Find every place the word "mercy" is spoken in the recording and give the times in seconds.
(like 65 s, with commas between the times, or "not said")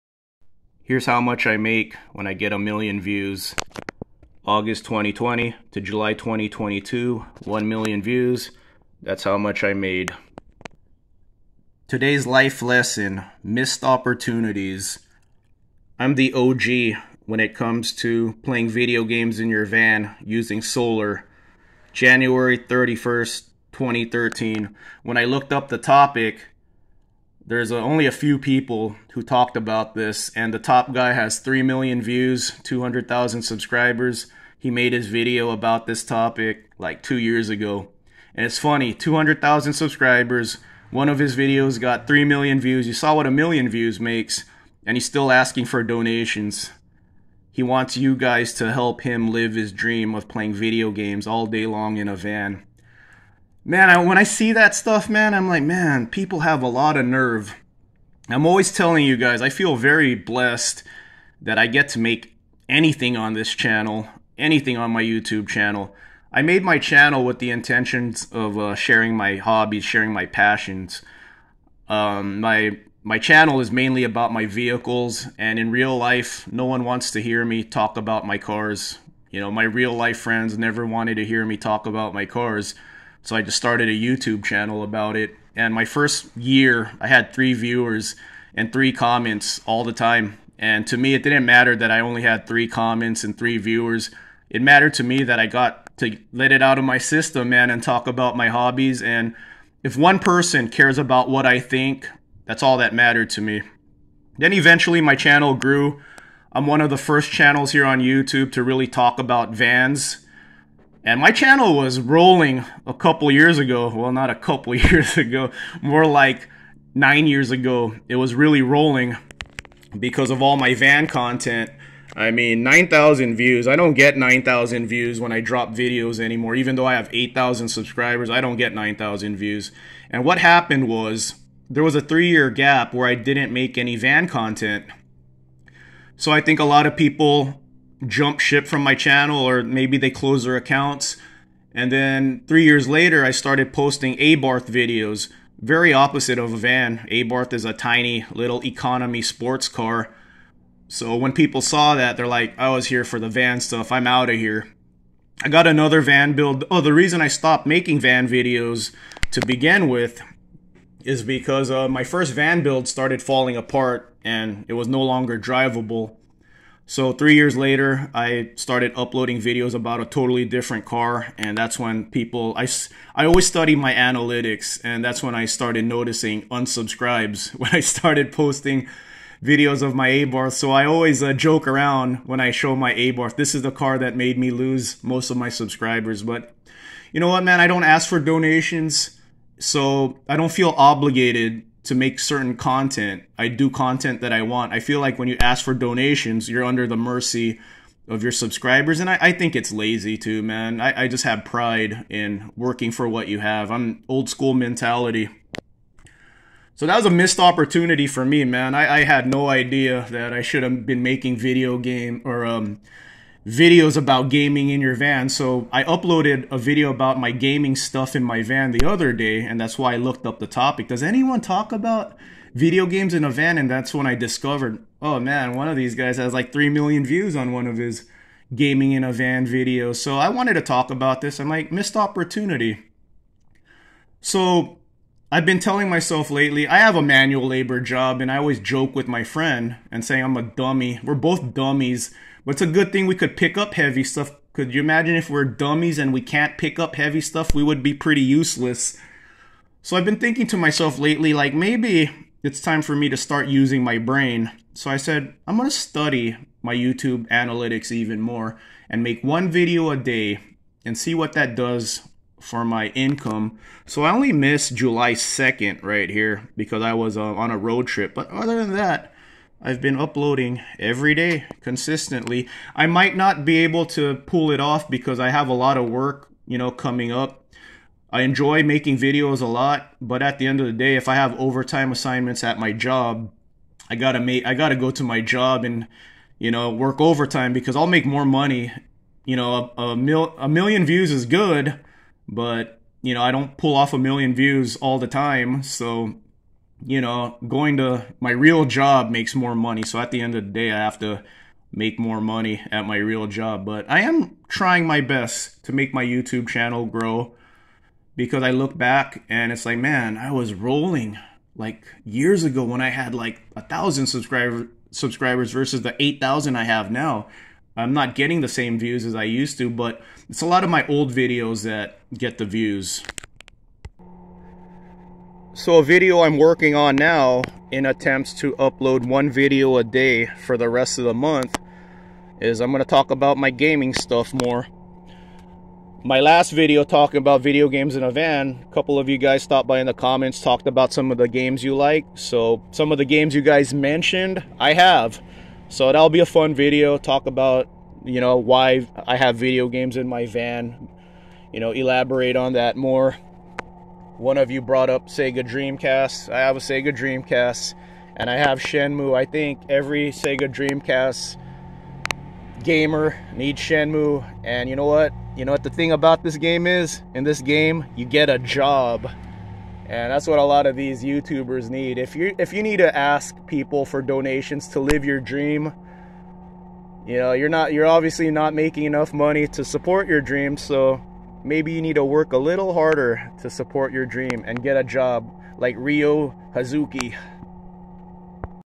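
196 s.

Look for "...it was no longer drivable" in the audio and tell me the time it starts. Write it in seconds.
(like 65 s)
164 s.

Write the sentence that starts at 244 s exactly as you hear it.
Could you imagine if we're dummies and we can't pick up heavy stuff?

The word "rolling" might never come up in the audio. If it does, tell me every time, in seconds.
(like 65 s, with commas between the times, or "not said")
111 s, 118 s, 310 s.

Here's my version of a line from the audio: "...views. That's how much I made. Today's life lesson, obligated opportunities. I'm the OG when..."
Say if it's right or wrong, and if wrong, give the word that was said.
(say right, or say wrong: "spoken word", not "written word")
wrong: "missed", not "obligated".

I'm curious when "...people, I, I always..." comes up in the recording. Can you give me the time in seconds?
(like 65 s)
172 s.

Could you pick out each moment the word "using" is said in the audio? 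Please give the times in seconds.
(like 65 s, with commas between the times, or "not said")
20 s, 253 s.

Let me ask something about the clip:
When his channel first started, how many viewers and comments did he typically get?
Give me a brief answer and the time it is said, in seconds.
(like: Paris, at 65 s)
3, at 87 s.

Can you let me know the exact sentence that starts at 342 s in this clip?
So some of the games you guys mentioned, I have.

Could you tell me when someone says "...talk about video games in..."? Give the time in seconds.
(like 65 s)
221 s.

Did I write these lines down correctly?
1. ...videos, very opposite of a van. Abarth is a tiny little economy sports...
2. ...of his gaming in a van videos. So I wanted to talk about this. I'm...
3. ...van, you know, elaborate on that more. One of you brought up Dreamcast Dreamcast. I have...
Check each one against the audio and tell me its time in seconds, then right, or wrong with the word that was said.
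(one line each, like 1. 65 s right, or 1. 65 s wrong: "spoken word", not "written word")
1. 144 s right
2. 227 s right
3. 350 s wrong: "Sega", not "Dreamcast".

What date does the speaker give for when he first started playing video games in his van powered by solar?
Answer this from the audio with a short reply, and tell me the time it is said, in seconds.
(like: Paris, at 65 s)
January 31st, 2013, at 21 s.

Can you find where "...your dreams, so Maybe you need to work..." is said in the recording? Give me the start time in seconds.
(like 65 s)
380 s.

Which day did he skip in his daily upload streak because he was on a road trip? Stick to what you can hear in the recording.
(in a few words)
July 2nd.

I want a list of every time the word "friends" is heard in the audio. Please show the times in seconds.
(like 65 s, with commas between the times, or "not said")
80 s, 239 s.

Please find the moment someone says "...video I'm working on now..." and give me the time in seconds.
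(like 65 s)
325 s.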